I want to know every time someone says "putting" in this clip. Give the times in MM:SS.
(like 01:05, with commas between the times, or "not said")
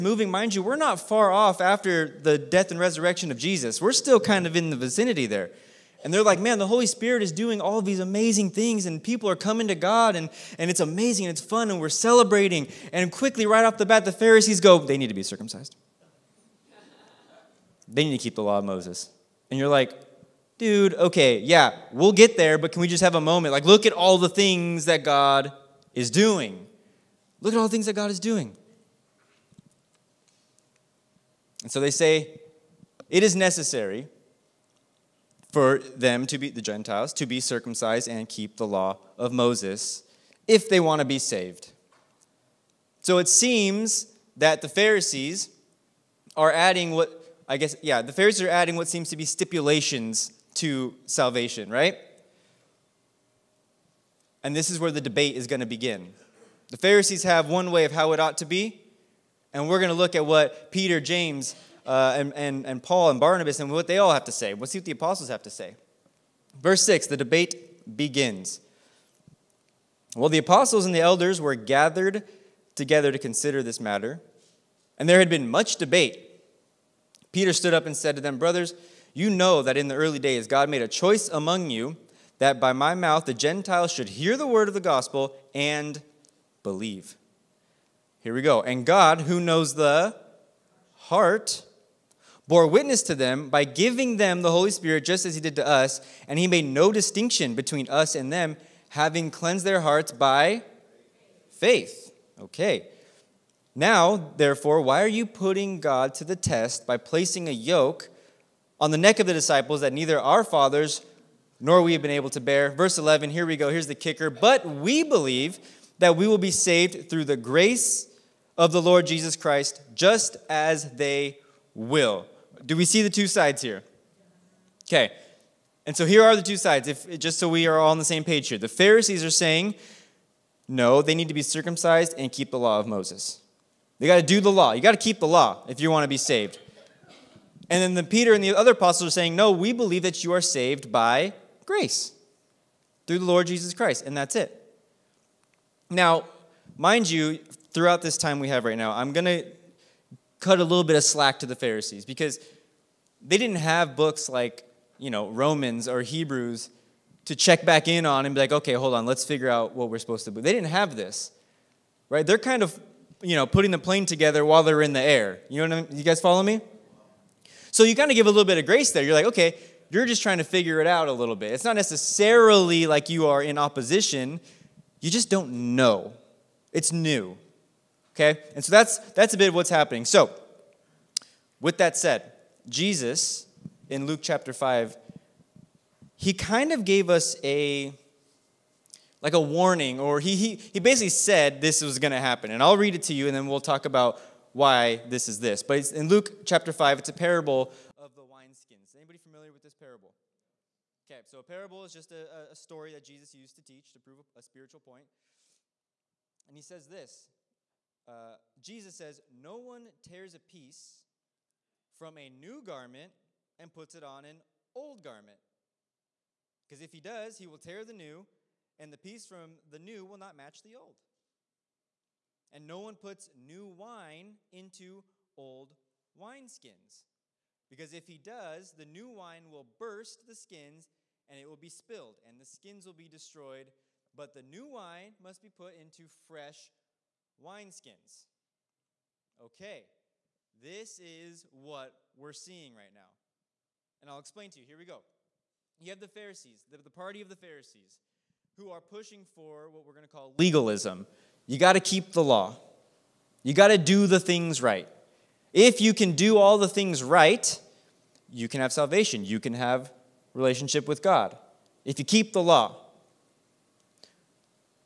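01:45, 02:43.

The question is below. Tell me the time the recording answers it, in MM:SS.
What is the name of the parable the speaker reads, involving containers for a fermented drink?
03:18.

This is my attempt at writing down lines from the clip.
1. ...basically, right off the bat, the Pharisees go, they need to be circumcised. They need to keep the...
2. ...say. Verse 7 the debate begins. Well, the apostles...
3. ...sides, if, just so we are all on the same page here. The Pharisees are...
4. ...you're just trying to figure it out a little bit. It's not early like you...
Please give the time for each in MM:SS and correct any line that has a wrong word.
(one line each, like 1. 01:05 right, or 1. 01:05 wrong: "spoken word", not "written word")
1. 00:13 wrong: "quickly", not "basically"
2. 01:05 wrong: "6", not "7"
3. 02:06 right
4. 02:49 wrong: "necessarily", not "early".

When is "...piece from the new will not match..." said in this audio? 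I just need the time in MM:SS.
03:38.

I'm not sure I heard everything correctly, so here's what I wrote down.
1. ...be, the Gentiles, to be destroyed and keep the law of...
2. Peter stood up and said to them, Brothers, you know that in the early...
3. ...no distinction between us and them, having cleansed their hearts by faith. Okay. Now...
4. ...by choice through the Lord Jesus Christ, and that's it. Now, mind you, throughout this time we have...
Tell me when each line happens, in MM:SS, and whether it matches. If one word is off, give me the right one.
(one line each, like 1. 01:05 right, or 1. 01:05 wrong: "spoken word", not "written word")
1. 00:36 wrong: "circumcised", not "destroyed"
2. 01:17 right
3. 01:36 right
4. 02:20 wrong: "grace", not "choice".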